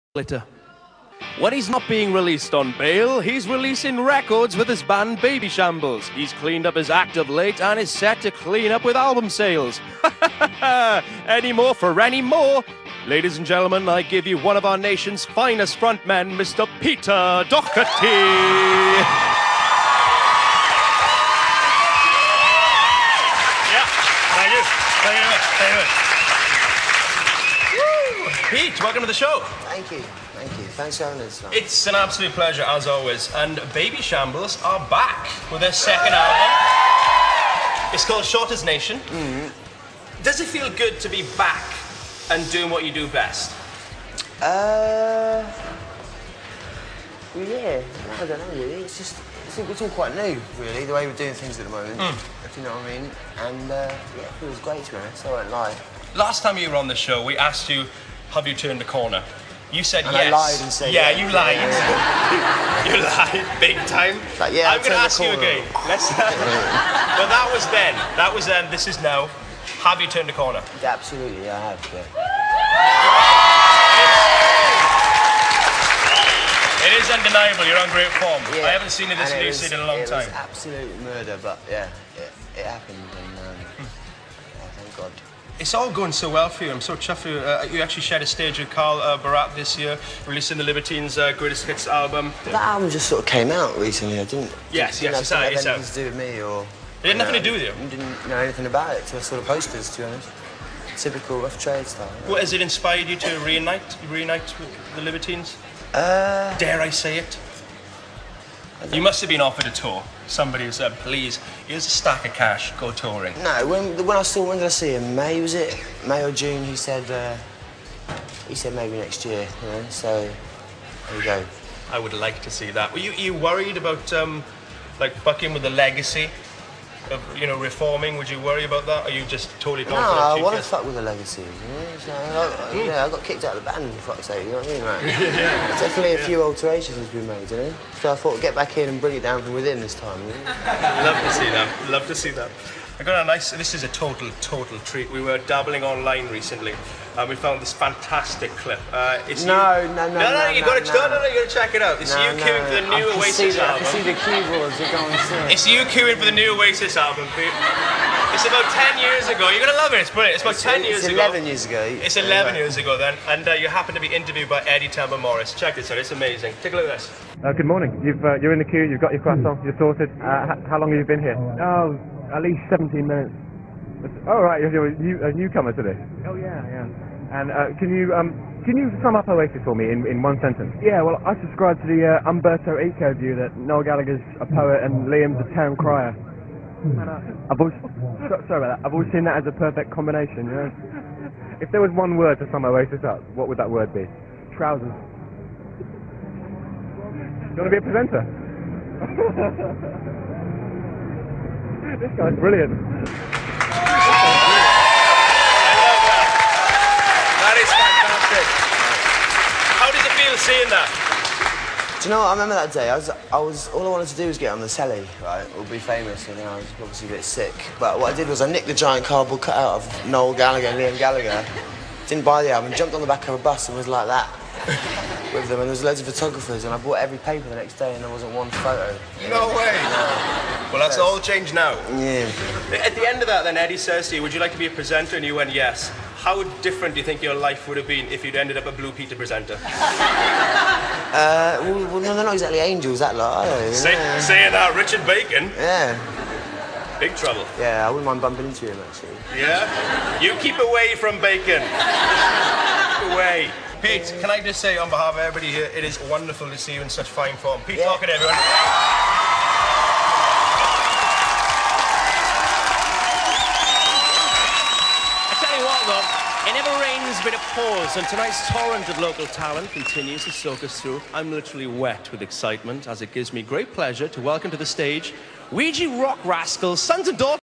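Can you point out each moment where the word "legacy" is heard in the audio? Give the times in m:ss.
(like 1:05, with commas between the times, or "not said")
2:05, 2:11.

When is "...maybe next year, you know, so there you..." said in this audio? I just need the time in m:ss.
1:58.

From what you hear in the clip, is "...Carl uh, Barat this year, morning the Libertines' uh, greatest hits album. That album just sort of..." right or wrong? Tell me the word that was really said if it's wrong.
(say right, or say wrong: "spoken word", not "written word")
wrong: "releasing", not "morning".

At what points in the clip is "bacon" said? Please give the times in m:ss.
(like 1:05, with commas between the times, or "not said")
4:05, 4:11.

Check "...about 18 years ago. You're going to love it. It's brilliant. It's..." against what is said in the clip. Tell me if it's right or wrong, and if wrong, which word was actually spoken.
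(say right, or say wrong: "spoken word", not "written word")
wrong: "10", not "18".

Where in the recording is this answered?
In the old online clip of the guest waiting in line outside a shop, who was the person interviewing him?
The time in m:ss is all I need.
2:44.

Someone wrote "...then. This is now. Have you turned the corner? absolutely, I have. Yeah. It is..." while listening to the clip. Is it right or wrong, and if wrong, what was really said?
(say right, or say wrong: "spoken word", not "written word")
right.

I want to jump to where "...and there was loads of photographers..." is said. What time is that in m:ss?
3:45.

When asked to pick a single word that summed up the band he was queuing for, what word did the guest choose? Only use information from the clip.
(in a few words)
Trousers.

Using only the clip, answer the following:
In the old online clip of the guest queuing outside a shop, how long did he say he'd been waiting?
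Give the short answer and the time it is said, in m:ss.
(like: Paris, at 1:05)
17 minutes, at 2:52.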